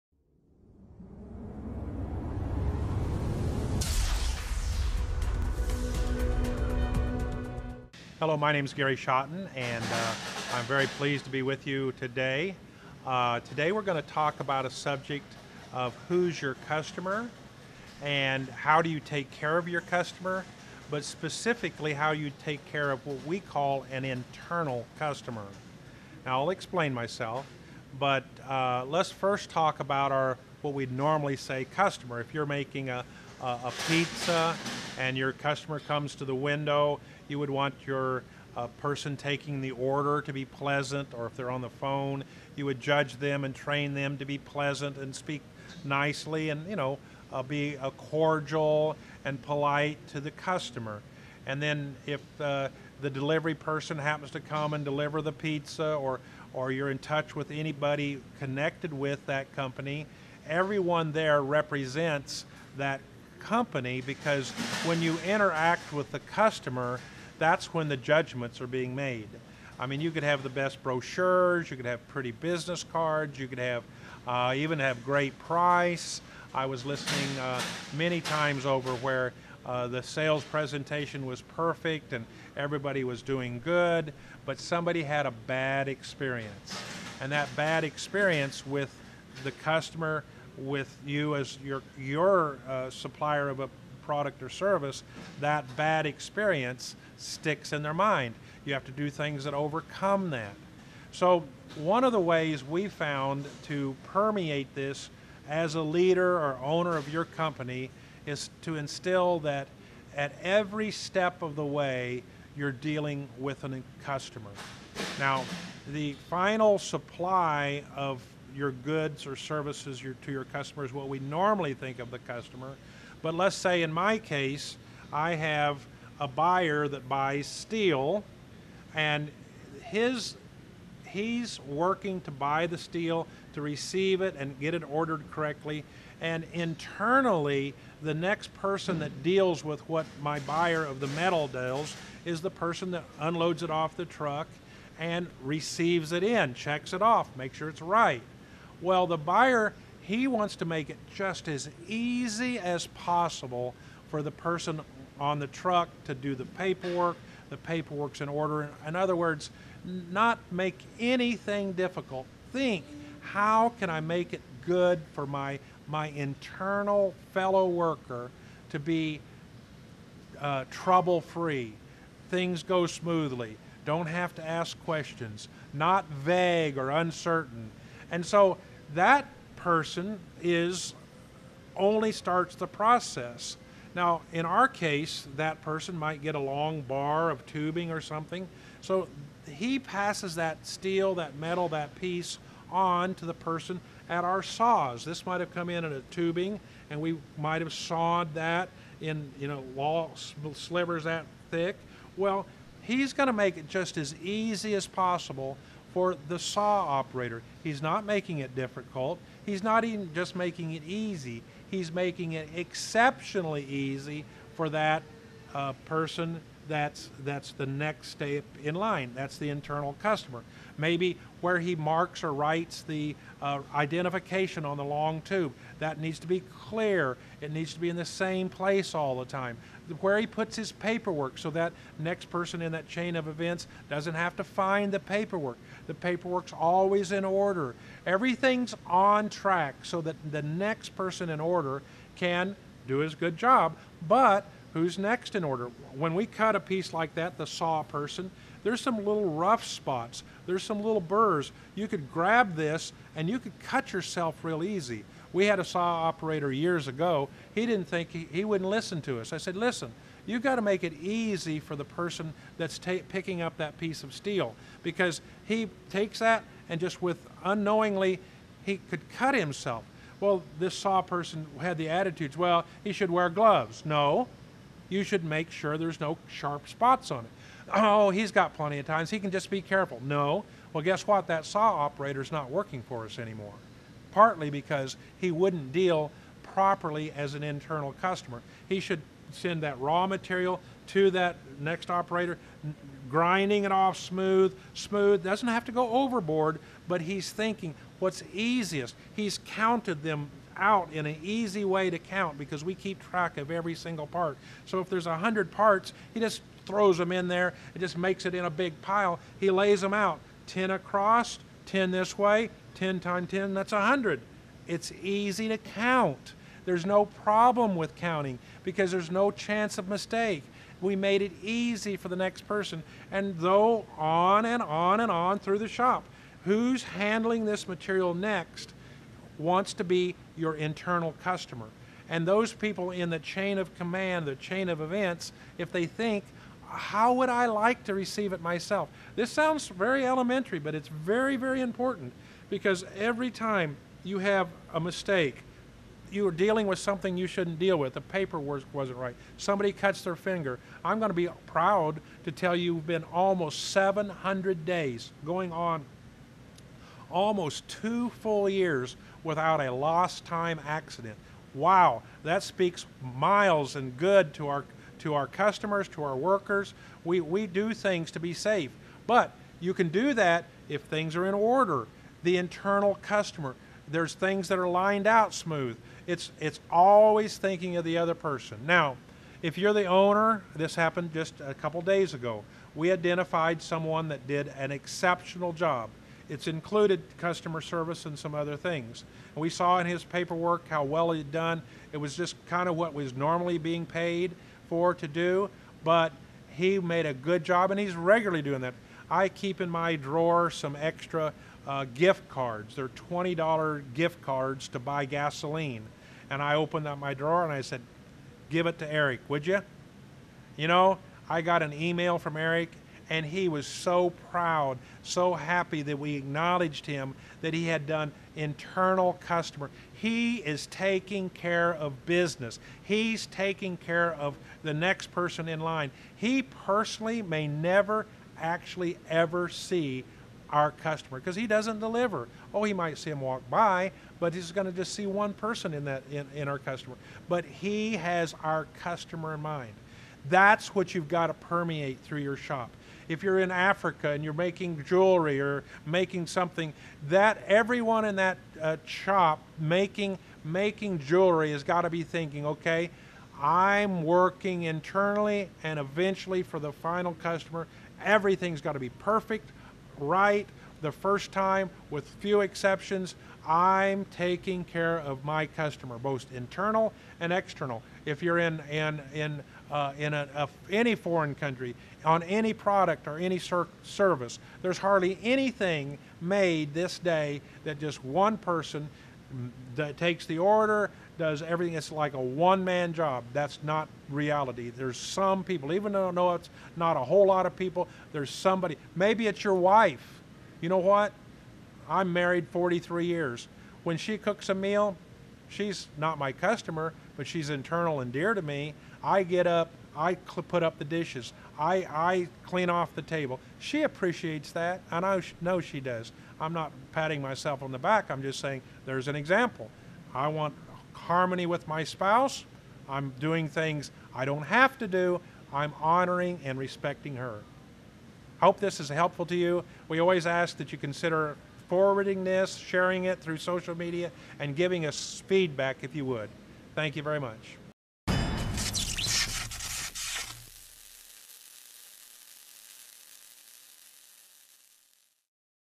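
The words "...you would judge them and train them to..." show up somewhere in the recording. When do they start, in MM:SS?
00:42.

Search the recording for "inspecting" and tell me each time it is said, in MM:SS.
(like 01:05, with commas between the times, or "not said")
not said.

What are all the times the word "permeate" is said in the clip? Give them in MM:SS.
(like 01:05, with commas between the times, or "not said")
01:44, 07:21.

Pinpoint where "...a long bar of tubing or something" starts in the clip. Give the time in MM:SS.
03:06.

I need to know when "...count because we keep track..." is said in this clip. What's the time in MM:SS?
05:01.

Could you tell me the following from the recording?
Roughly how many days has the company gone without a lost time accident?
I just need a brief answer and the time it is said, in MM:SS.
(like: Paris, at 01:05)
700, at 05:53.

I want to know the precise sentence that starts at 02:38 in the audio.
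In other words, not make anything difficult.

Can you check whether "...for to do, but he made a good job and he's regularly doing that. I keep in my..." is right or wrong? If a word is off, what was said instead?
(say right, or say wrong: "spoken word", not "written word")
right.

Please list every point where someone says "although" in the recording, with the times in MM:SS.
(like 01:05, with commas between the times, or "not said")
not said.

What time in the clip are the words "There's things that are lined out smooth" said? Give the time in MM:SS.
06:13.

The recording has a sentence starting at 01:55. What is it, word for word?
Now, the final supply of your goods or services your, to your customers, what we normally think of the customer.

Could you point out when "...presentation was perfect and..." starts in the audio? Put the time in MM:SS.
01:20.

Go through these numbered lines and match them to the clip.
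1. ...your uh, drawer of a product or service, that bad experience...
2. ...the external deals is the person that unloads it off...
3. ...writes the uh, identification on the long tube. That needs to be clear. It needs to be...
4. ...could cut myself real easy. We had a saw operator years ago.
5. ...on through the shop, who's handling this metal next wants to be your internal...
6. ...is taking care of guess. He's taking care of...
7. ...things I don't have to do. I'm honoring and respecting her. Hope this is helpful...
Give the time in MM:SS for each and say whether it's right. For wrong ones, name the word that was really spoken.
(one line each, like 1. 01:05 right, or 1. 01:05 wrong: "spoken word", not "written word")
1. 01:31 wrong: "supplier", not "drawer"
2. 02:21 wrong: "metal", not "external"
3. 03:42 right
4. 04:13 wrong: "yourself", not "myself"
5. 05:25 wrong: "material", not "metal"
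6. 07:00 wrong: "business", not "guess"
7. 08:33 right.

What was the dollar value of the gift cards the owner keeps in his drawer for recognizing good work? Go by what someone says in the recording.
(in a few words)
$20.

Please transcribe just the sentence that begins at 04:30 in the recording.
Well, this saw person had the attitudes, well, he should wear gloves.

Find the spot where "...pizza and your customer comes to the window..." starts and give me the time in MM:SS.
00:33.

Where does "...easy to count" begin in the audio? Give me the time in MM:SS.
05:15.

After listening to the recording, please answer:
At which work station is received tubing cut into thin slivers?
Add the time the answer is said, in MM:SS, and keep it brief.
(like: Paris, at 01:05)
Saws, at 03:14.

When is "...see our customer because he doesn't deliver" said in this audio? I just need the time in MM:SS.
07:09.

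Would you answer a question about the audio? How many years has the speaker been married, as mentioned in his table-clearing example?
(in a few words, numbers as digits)
43.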